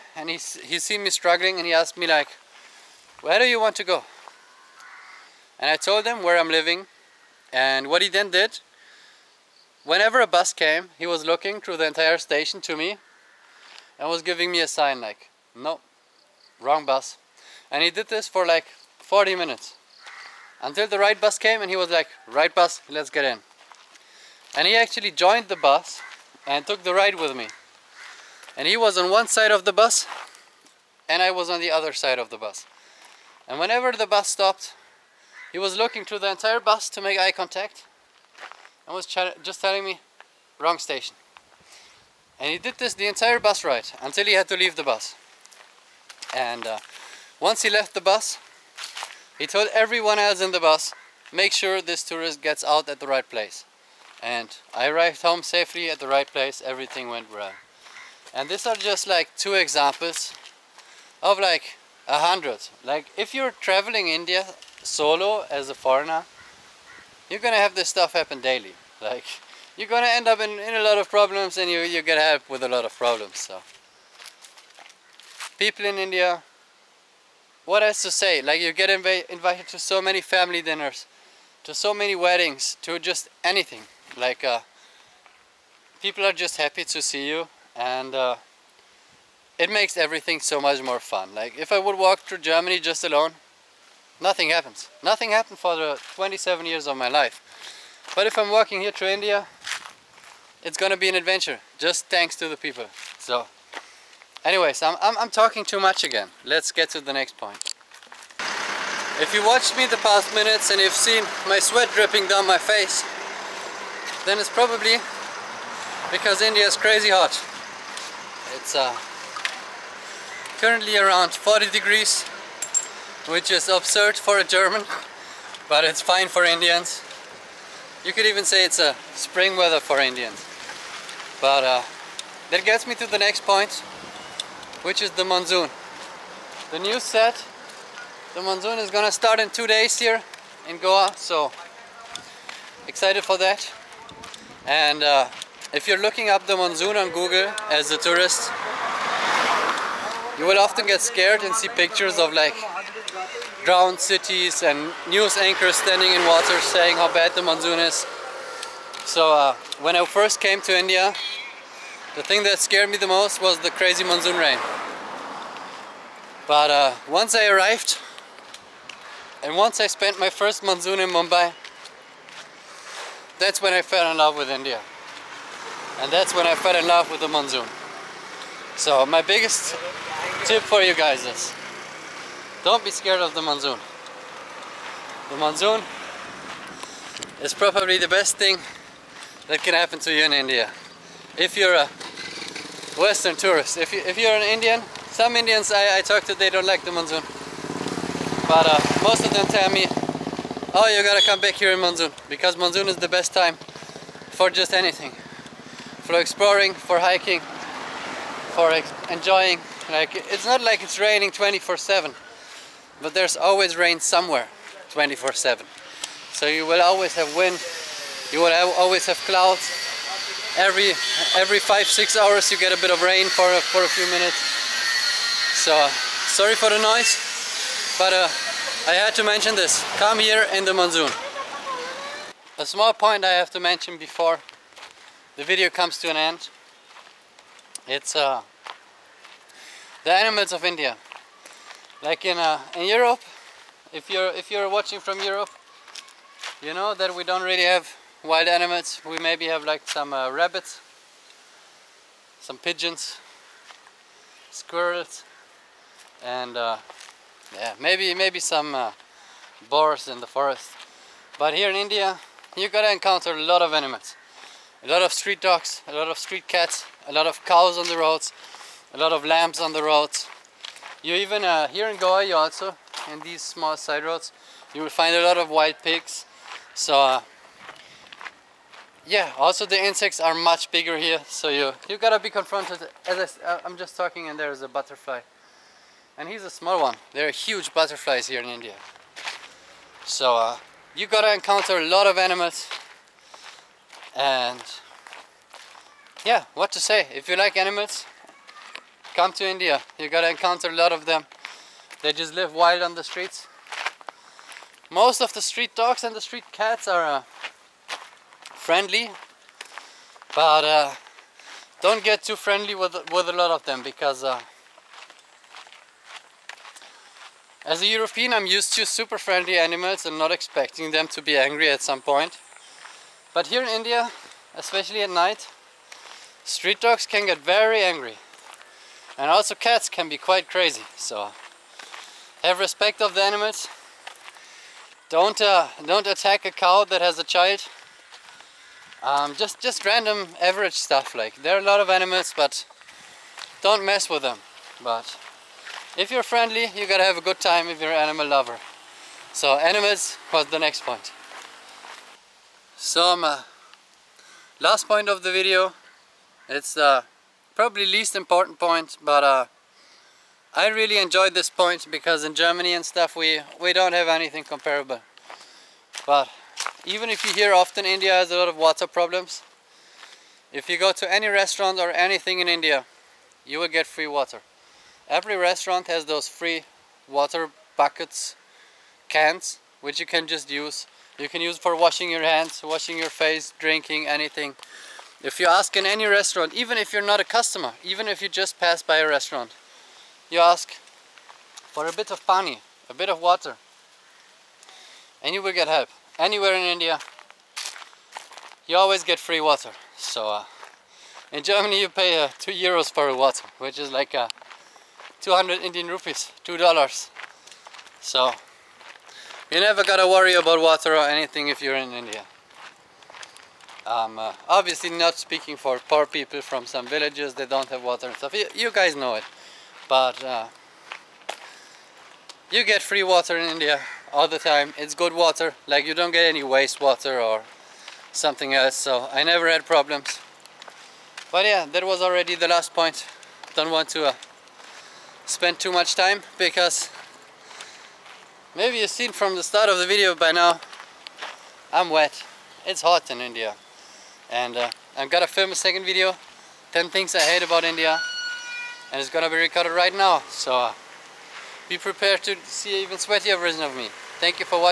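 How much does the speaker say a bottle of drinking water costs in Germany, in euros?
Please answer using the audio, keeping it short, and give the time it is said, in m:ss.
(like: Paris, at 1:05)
2 euros, at 6:42.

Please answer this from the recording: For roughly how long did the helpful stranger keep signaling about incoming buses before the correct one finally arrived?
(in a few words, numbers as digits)
40 minutes.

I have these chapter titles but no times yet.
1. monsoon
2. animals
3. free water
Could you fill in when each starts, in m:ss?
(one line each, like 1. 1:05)
1. 1:47
2. 3:50
3. 5:51.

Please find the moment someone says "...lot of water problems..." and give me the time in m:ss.
6:08.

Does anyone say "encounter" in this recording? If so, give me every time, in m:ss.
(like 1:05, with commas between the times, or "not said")
4:22, 4:51, 5:00.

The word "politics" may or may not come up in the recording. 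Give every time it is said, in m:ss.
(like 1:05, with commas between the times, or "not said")
not said.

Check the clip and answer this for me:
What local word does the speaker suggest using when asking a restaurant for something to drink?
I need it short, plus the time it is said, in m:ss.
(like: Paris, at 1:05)
Pani, at 6:32.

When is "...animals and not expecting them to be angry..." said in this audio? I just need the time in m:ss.
5:19.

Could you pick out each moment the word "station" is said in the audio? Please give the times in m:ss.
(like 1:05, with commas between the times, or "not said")
0:12, 0:40.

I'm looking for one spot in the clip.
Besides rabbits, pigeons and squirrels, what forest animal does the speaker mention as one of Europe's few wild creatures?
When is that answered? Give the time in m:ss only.
4:19.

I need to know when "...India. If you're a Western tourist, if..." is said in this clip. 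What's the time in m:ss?
3:10.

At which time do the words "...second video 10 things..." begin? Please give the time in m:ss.
7:25.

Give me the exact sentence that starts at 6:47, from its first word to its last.
So you never gotta worry about water or anything if you're in India.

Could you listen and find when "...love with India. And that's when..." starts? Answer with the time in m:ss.
2:54.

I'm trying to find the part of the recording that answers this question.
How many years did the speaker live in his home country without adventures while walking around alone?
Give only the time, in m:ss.
1:36.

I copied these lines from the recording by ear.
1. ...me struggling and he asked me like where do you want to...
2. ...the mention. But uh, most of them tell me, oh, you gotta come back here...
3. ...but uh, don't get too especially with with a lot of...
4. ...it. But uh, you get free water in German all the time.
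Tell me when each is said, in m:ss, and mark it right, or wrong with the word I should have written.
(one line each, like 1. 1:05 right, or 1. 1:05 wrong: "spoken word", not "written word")
1. 0:01 right
2. 3:16 wrong: "monsoon", not "mention"
3. 5:10 wrong: "friendly", not "especially"
4. 6:59 wrong: "India", not "German".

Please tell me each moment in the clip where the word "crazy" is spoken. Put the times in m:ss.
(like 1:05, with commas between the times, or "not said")
1:56, 2:43, 5:30.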